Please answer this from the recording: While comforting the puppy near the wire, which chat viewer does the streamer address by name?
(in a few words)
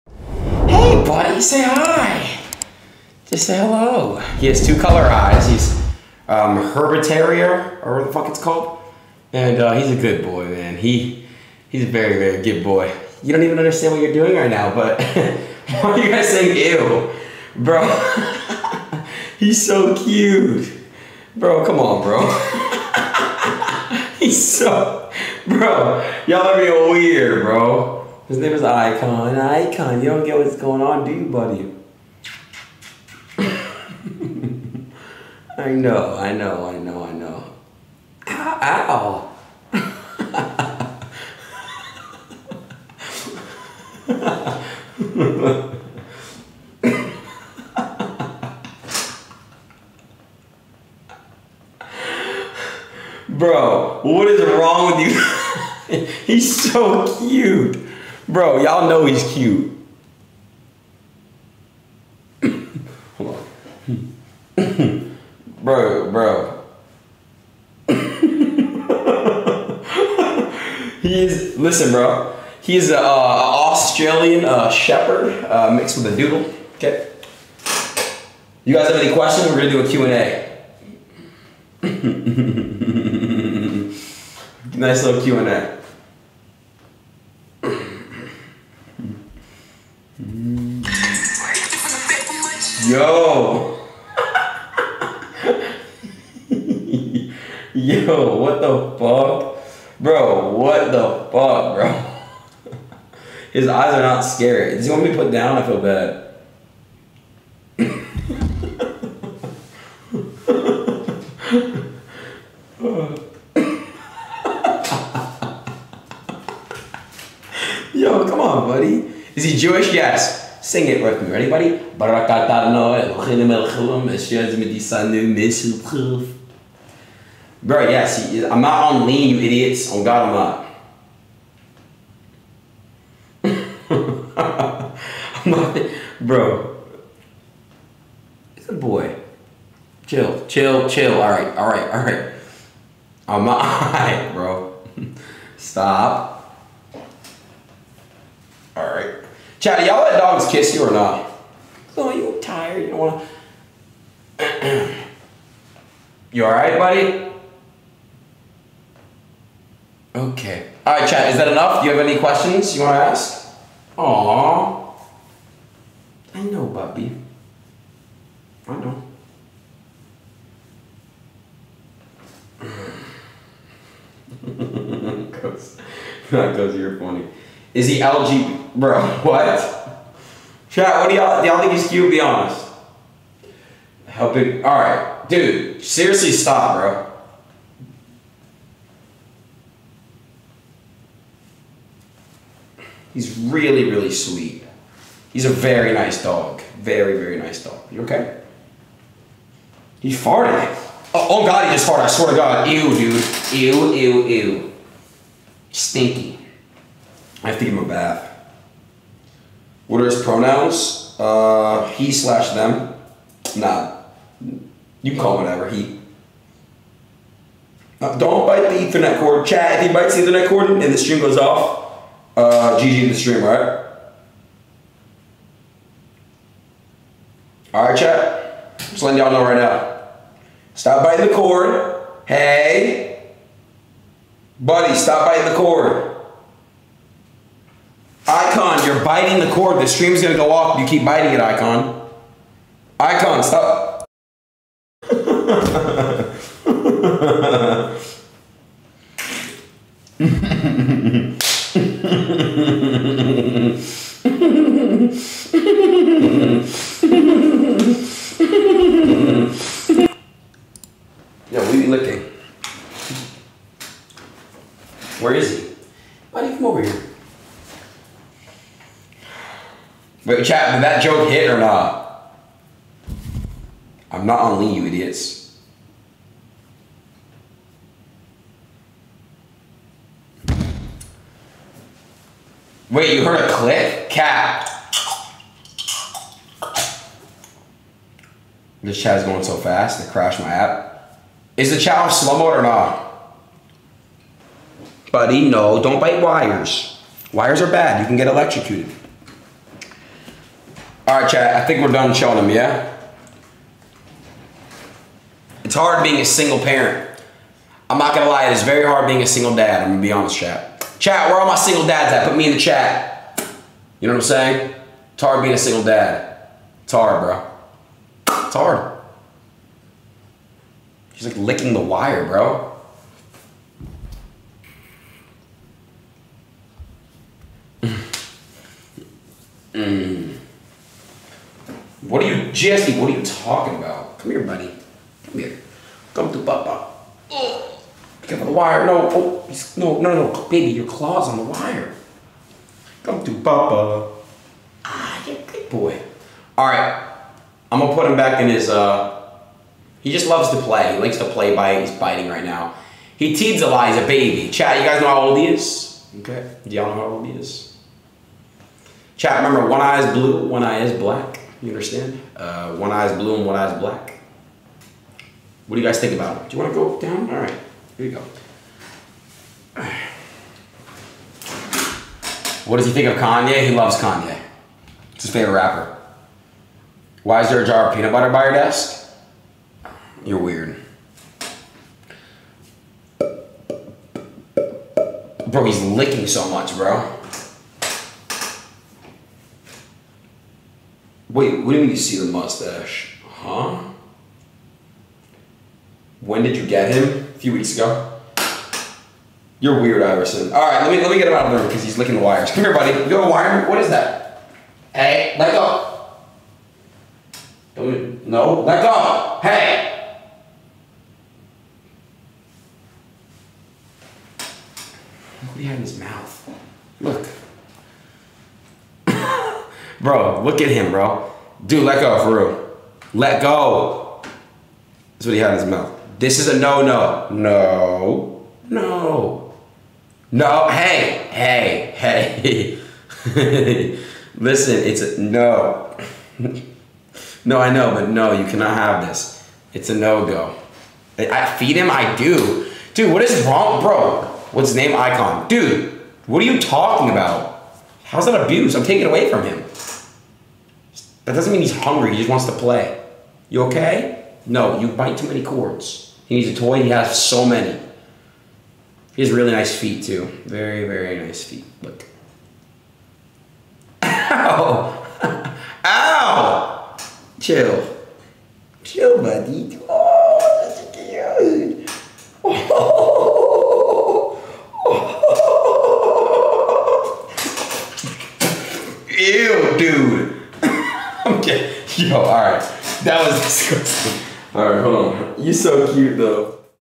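Jesse.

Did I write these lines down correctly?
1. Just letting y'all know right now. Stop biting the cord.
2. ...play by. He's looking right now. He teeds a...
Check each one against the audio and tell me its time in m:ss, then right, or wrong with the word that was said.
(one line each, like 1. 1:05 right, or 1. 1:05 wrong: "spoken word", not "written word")
1. 3:48 right
2. 5:51 wrong: "biting", not "looking".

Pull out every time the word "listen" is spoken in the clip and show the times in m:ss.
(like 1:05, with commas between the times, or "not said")
1:11, 7:14.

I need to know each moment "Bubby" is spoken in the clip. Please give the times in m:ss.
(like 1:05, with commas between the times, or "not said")
2:46.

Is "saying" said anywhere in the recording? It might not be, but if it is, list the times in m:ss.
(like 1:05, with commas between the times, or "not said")
0:16, 5:14.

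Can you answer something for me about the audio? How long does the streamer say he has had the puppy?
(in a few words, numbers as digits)
A few weeks.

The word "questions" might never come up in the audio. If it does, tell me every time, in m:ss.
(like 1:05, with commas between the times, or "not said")
1:19, 2:42.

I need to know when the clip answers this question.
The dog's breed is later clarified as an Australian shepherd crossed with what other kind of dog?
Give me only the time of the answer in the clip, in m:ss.
1:16.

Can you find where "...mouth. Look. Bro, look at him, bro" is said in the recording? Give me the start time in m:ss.
6:55.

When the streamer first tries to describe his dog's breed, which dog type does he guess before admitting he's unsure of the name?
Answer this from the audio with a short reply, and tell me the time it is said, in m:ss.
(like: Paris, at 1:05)
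Terrier, at 0:07.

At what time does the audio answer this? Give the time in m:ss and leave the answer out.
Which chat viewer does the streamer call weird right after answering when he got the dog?
6:40.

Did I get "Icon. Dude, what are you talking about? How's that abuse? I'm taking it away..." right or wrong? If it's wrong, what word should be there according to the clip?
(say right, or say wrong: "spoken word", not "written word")
right.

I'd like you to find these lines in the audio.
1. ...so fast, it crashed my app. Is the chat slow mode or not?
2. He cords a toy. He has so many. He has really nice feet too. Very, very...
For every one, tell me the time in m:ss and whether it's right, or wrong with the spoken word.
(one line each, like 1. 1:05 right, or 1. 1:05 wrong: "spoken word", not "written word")
1. 4:49 right
2. 7:36 wrong: "needs", not "cords".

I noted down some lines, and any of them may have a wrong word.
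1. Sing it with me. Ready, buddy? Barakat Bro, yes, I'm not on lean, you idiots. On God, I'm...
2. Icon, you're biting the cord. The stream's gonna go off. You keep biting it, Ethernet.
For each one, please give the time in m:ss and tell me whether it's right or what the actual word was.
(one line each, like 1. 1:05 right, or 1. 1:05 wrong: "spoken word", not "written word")
1. 2:00 right
2. 3:58 wrong: "Icon", not "Ethernet".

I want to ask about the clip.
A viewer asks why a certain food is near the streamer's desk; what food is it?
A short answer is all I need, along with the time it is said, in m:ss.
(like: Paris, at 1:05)
peanut butter, at 6:17.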